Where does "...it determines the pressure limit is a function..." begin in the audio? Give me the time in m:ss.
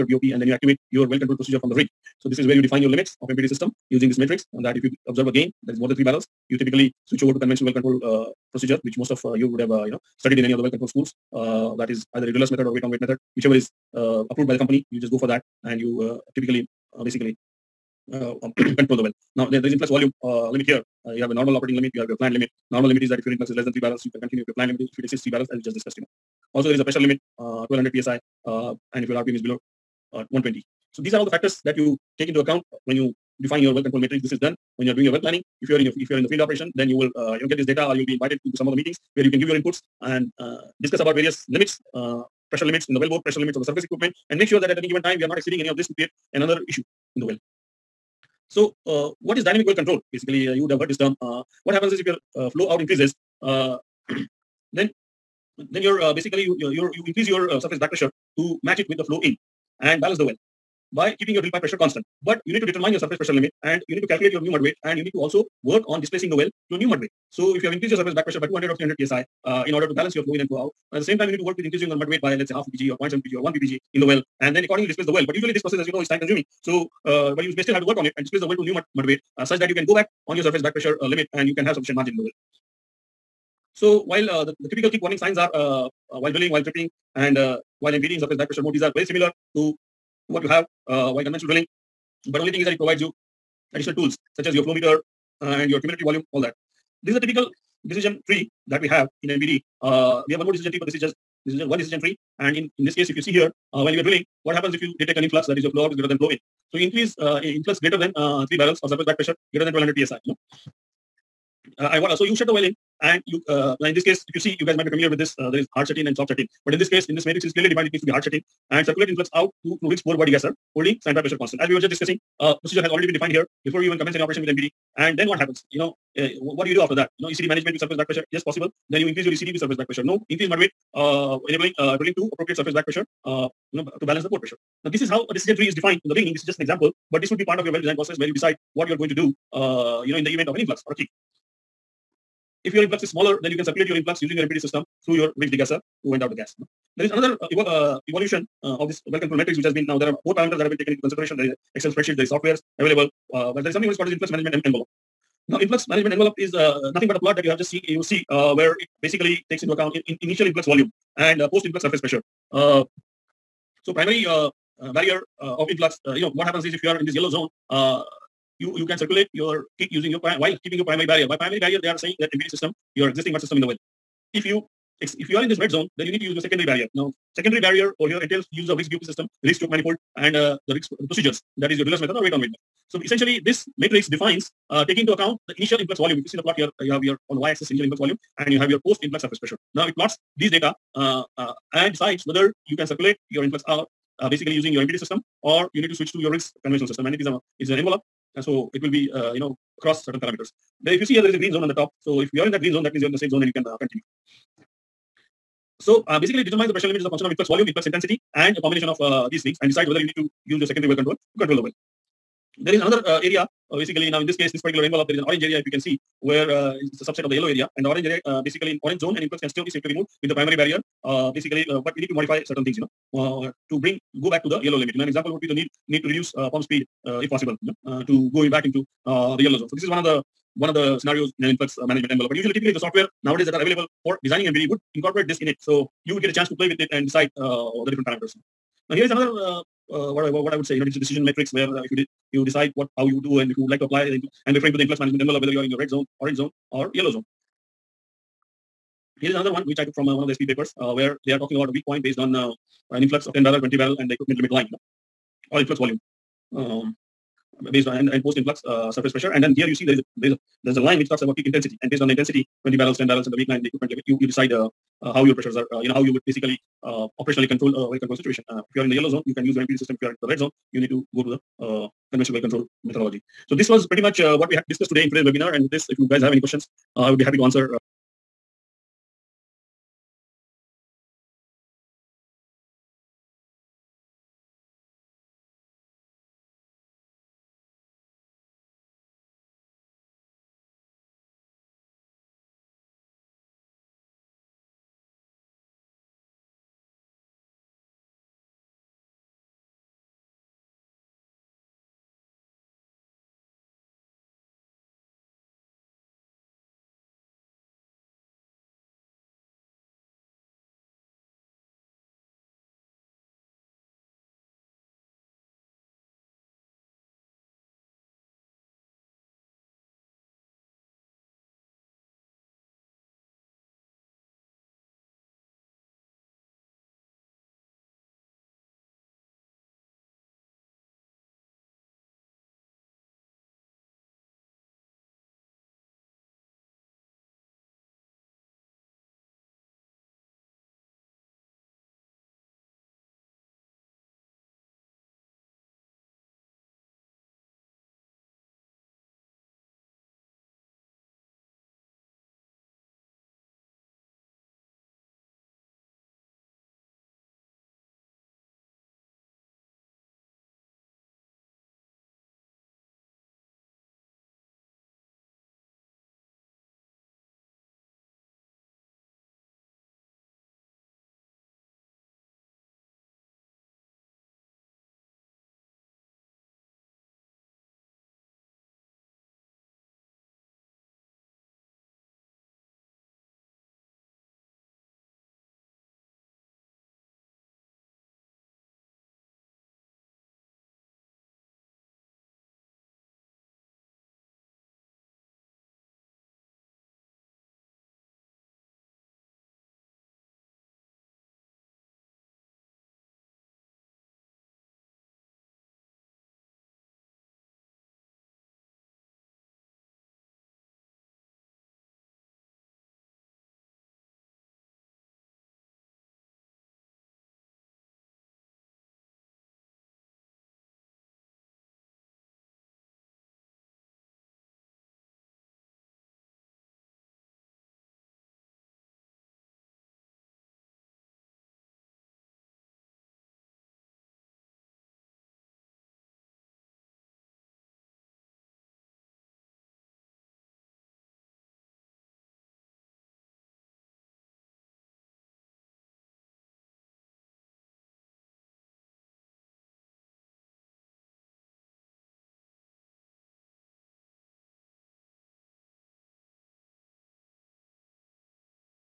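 3:26.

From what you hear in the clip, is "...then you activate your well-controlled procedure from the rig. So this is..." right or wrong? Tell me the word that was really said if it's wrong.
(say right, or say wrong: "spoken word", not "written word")
right.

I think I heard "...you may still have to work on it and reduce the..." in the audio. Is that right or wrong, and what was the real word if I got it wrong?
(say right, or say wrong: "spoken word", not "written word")
wrong: "displace", not "reduce".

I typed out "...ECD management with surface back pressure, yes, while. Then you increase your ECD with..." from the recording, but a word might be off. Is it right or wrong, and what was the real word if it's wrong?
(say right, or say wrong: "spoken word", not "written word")
wrong: "possible", not "while".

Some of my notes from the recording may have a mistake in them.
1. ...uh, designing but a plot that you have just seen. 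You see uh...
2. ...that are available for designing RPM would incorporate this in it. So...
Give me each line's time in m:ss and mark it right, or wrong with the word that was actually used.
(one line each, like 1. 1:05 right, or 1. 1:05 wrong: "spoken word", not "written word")
1. 2:36 wrong: "nothing", not "designing"
2. 3:53 wrong: "MPD", not "RPM".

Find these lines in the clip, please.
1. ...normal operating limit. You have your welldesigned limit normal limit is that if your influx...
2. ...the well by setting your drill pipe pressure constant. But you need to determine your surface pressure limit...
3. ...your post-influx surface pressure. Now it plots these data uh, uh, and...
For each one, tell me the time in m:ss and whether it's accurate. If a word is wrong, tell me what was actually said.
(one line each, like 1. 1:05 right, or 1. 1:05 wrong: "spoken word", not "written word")
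1. 0:21 wrong: "planned", not "welldesigned"
2. 1:00 wrong: "keeping", not "setting"
3. 3:08 right.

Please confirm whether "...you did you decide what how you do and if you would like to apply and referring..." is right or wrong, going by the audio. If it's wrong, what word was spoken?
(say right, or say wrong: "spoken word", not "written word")
right.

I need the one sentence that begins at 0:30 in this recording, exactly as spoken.
So these are all the factors that you take into account when you define your well control matrix.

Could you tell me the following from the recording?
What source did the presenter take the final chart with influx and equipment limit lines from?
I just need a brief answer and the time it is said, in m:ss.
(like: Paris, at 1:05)
SPE papers, at 4:10.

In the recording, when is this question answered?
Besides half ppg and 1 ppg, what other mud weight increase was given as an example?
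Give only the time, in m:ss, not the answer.
1:13.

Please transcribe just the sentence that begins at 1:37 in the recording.
This is a typical decision tree that we have in MPD.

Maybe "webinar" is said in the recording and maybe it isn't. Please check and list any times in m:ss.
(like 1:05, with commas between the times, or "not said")
4:35.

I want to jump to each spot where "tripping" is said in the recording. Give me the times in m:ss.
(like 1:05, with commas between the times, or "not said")
1:26.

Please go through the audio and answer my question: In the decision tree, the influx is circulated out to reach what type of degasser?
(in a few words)
poor boy degasser.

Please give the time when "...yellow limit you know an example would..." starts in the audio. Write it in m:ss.
3:44.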